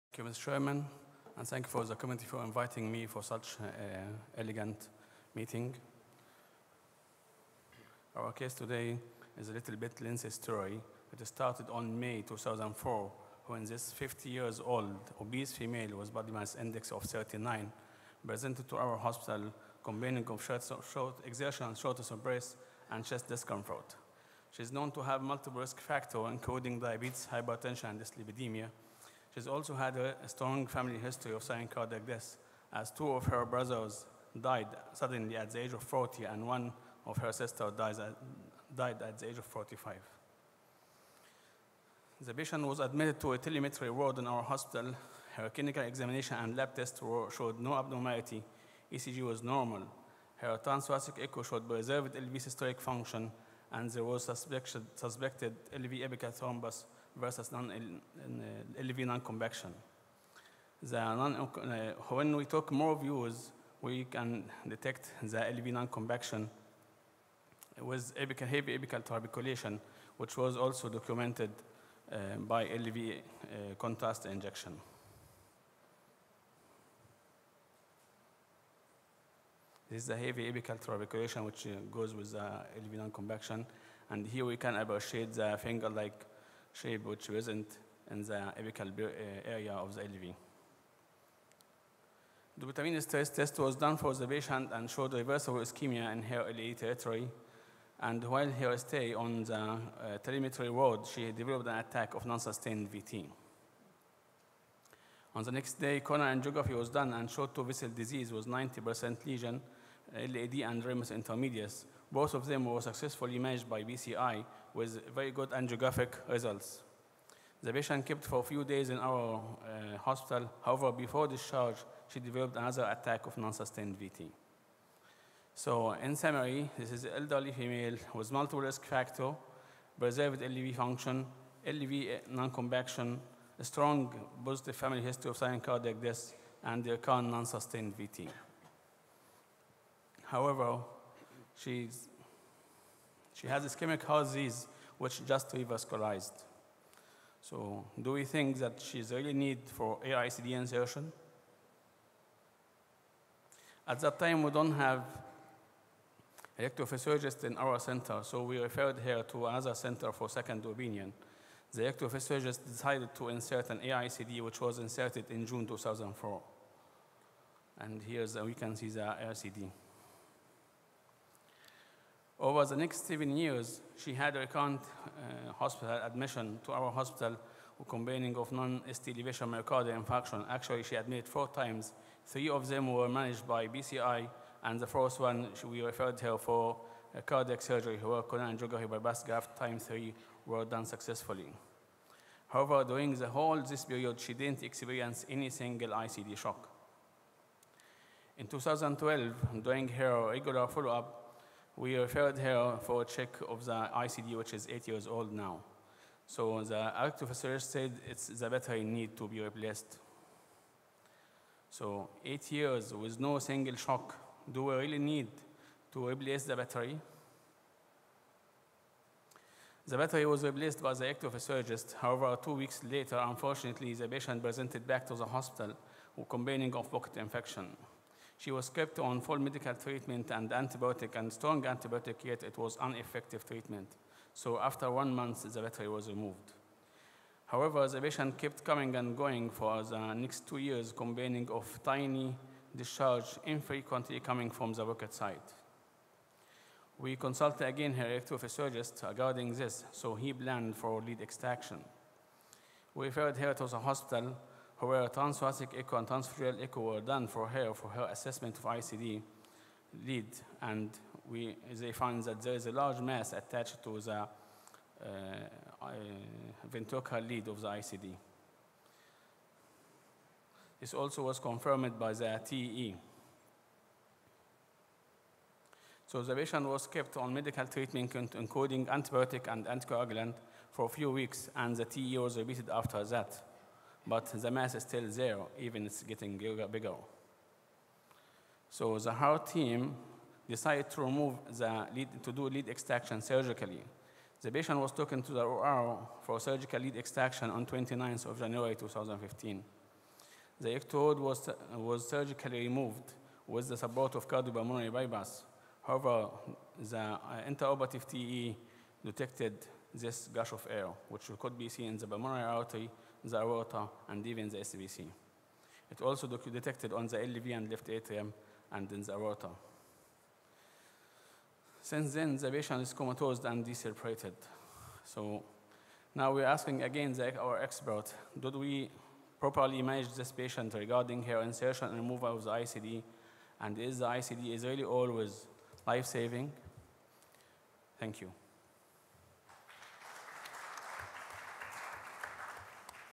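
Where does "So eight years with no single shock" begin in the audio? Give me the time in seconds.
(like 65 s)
211 s.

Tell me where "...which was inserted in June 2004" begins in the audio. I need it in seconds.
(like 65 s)
164 s.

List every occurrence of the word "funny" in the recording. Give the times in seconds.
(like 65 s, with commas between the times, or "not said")
not said.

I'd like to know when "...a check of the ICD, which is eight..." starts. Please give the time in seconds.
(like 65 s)
203 s.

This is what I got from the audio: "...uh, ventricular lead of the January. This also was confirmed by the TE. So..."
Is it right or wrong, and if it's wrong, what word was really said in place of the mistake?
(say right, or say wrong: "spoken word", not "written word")
wrong: "ICD", not "January".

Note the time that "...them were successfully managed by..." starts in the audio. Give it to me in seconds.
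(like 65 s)
112 s.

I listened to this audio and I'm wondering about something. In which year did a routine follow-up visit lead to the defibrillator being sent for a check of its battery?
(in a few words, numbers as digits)
2012.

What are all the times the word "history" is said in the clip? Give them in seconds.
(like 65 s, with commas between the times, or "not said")
30 s, 135 s.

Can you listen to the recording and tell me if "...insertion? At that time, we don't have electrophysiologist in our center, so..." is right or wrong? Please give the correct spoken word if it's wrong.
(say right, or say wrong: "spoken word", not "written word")
right.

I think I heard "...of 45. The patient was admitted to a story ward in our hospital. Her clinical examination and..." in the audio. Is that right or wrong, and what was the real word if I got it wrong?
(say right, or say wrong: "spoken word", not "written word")
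wrong: "telemetry", not "story".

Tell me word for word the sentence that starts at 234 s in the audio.
So after one month, the battery was removed.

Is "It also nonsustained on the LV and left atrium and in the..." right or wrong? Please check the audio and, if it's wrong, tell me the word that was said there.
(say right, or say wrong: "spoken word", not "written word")
wrong: "detected", not "nonsustained".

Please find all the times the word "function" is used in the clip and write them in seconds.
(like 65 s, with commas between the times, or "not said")
52 s, 130 s.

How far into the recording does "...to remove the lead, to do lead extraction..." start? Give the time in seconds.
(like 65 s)
290 s.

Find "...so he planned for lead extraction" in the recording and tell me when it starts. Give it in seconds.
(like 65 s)
249 s.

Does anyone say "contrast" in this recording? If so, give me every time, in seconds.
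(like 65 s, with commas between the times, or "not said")
73 s.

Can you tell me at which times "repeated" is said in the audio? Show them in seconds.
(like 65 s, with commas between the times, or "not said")
282 s.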